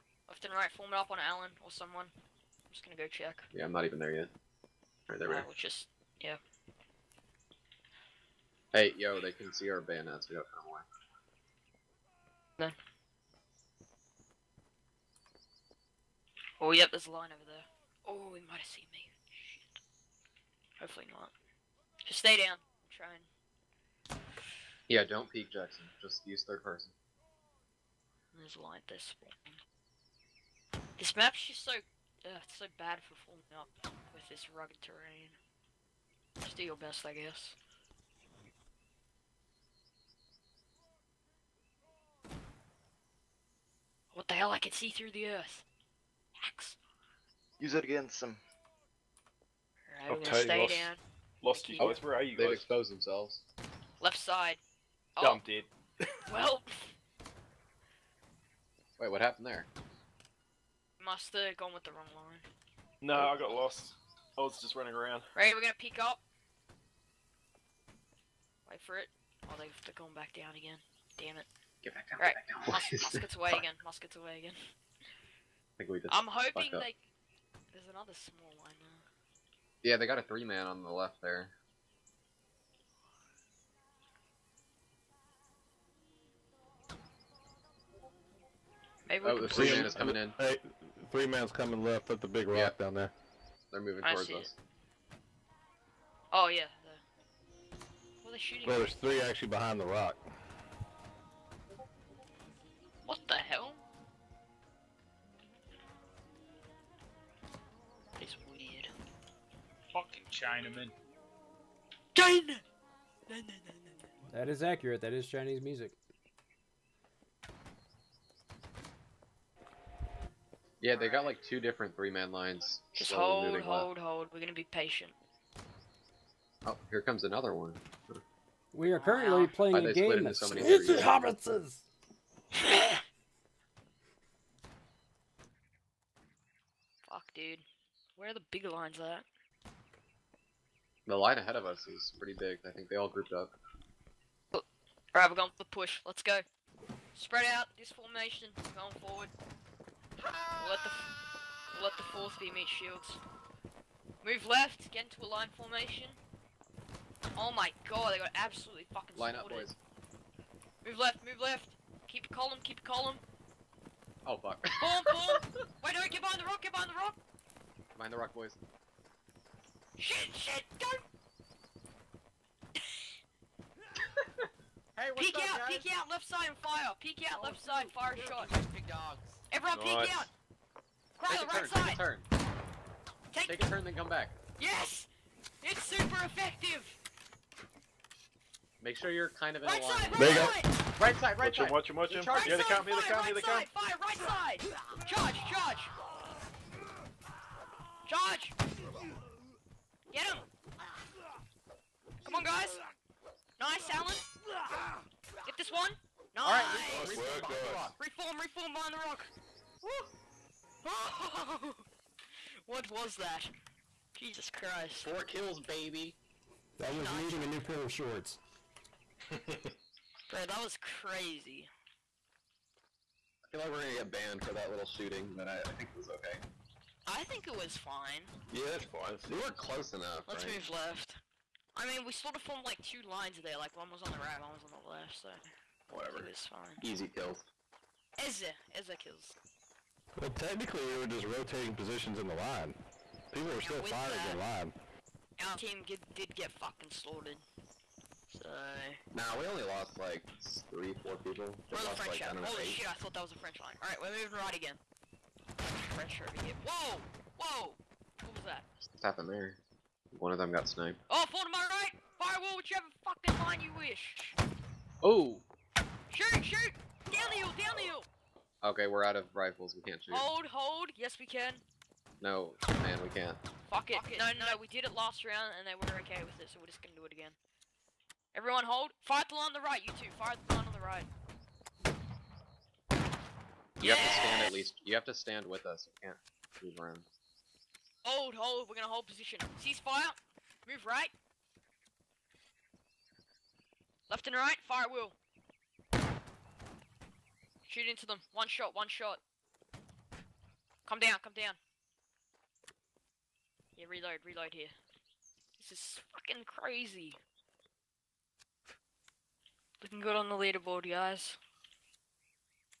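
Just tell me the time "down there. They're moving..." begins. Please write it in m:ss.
1:32.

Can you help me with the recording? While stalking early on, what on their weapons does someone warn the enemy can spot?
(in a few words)
bayonets.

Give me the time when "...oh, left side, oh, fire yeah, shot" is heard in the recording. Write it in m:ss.
2:57.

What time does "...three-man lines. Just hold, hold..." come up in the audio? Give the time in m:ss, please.
2:01.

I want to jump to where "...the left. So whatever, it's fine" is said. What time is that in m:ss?
3:54.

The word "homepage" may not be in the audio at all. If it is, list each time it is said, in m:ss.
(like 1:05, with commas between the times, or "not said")
not said.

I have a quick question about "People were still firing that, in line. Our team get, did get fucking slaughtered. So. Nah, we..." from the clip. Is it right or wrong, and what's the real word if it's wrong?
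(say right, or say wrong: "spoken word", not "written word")
right.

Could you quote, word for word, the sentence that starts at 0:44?
I can see through the earth.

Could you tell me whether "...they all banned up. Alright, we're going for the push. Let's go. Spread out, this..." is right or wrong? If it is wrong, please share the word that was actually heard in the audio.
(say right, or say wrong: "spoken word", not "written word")
wrong: "grouped", not "banned".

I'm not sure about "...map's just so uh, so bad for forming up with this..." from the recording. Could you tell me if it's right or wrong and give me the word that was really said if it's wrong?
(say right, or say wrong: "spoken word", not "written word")
right.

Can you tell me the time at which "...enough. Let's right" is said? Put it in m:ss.
3:49.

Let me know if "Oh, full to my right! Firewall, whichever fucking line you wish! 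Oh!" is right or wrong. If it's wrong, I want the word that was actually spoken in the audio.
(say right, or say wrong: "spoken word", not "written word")
right.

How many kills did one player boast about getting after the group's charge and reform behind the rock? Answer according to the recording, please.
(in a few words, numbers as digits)
4.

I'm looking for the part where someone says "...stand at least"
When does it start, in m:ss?
4:44.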